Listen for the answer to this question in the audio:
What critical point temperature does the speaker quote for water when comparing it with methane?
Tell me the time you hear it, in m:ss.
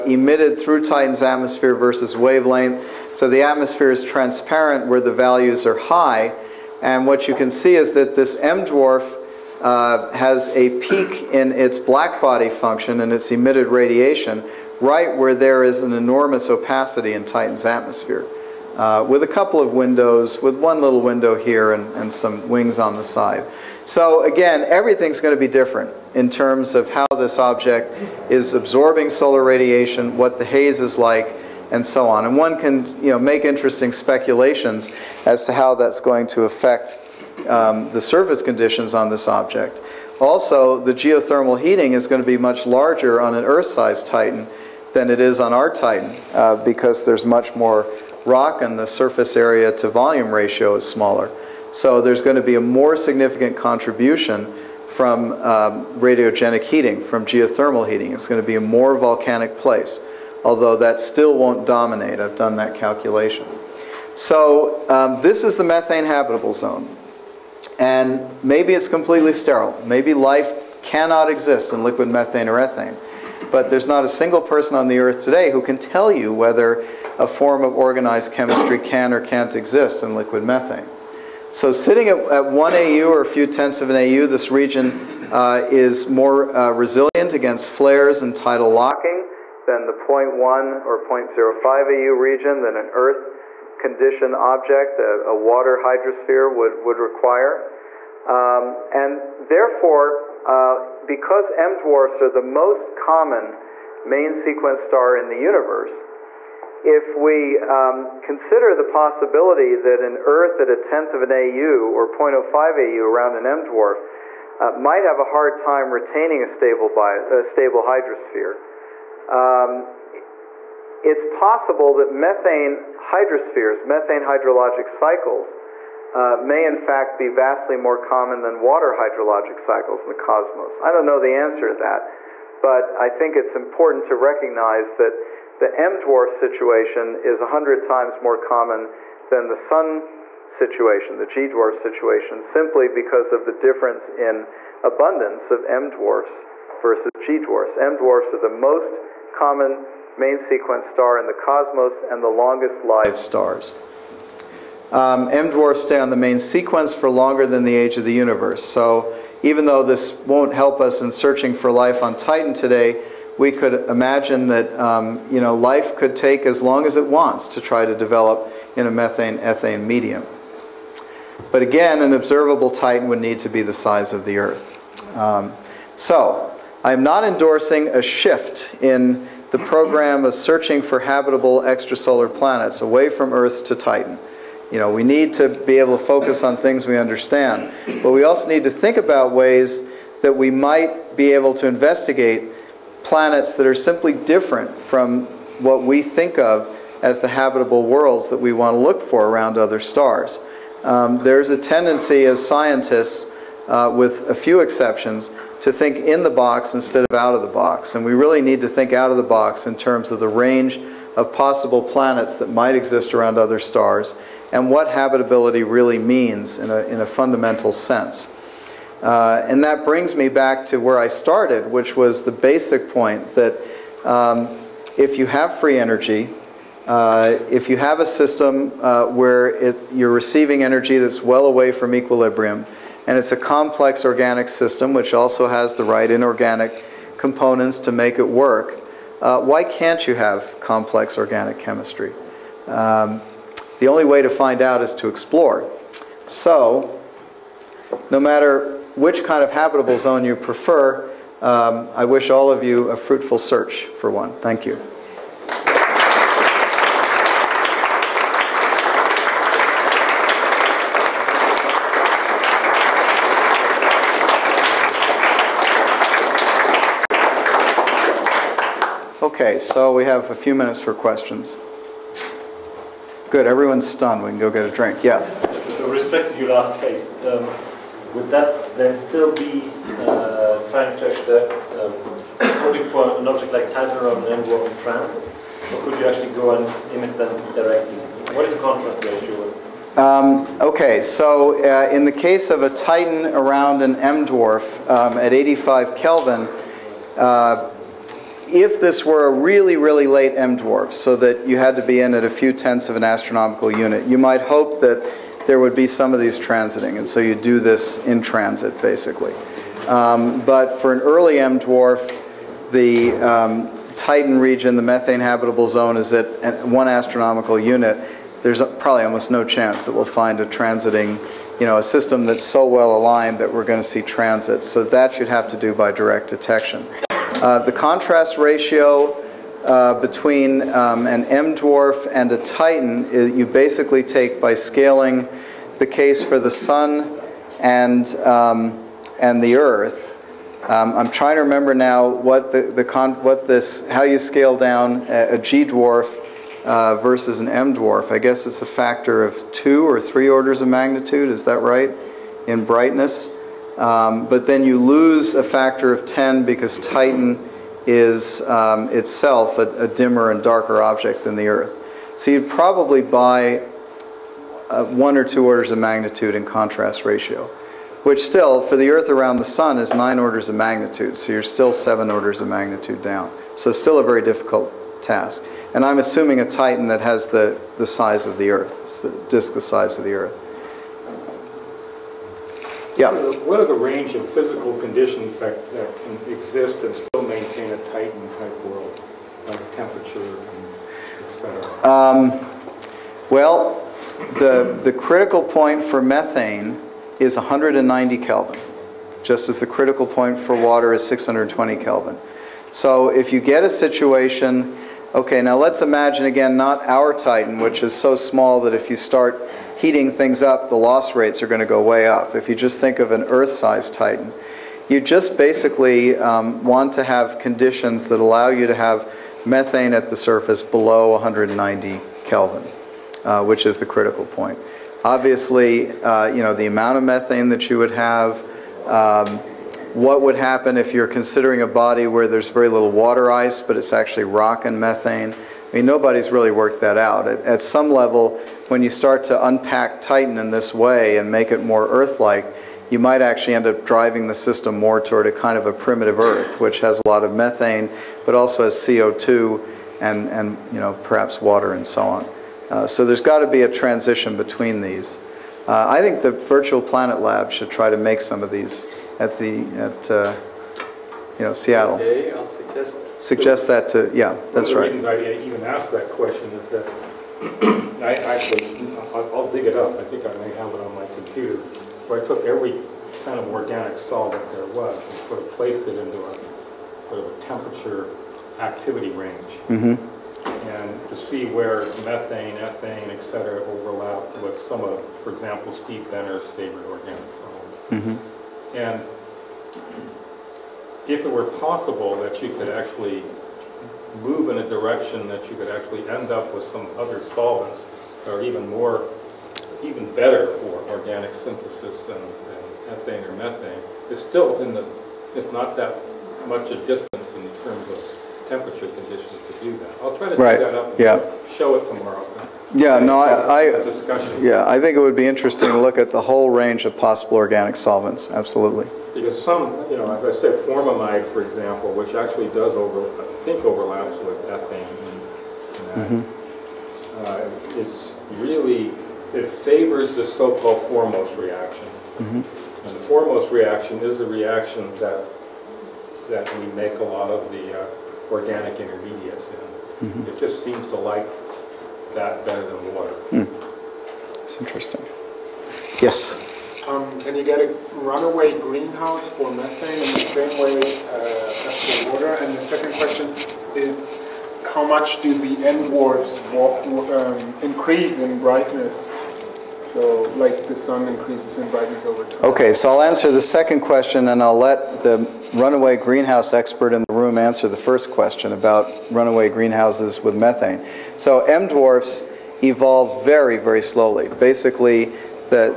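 6:41.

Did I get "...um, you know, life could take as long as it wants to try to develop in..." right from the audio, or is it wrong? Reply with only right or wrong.
right.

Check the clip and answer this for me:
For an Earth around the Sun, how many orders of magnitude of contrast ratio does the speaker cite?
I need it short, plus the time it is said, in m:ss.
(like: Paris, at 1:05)
9, at 6:09.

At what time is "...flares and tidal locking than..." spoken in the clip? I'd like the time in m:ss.
1:27.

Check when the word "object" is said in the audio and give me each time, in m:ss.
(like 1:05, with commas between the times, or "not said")
0:27, 0:39, 1:34, 4:43, 6:00.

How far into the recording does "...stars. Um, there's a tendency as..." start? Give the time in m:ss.
3:19.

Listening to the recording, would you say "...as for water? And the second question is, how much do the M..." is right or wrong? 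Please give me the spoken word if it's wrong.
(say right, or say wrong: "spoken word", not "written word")
right.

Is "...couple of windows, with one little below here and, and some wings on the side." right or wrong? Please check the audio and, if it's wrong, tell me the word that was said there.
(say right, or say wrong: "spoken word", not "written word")
wrong: "window", not "below".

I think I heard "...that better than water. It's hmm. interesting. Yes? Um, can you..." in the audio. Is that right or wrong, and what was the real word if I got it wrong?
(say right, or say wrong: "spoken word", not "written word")
right.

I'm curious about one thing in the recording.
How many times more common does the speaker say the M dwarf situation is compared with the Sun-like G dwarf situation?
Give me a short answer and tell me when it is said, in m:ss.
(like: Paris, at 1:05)
100 times, at 2:17.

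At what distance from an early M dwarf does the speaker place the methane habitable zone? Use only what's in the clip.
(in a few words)
1 astronomical unit.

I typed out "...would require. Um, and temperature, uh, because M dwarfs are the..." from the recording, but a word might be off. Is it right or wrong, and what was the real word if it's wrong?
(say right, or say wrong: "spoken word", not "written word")
wrong: "therefore", not "temperature".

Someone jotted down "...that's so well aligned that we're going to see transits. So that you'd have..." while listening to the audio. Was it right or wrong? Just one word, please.
right.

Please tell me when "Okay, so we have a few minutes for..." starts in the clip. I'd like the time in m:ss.
4:29.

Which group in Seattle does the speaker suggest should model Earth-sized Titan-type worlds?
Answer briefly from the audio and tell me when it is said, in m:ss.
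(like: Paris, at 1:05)
Virtual Planet Lab, at 7:36.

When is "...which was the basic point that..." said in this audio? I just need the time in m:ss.
3:41.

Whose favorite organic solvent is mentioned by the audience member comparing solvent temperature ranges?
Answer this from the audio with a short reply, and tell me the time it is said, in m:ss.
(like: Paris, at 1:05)
Steve Benner, at 8:05.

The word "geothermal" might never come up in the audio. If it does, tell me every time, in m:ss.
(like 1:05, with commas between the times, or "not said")
0:40, 0:57.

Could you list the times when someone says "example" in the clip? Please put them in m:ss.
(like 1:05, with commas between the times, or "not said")
8:05, 8:41.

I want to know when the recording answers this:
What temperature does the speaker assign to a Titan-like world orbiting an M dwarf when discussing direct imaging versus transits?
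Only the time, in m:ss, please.
4:55.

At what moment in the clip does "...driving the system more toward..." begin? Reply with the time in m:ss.
7:23.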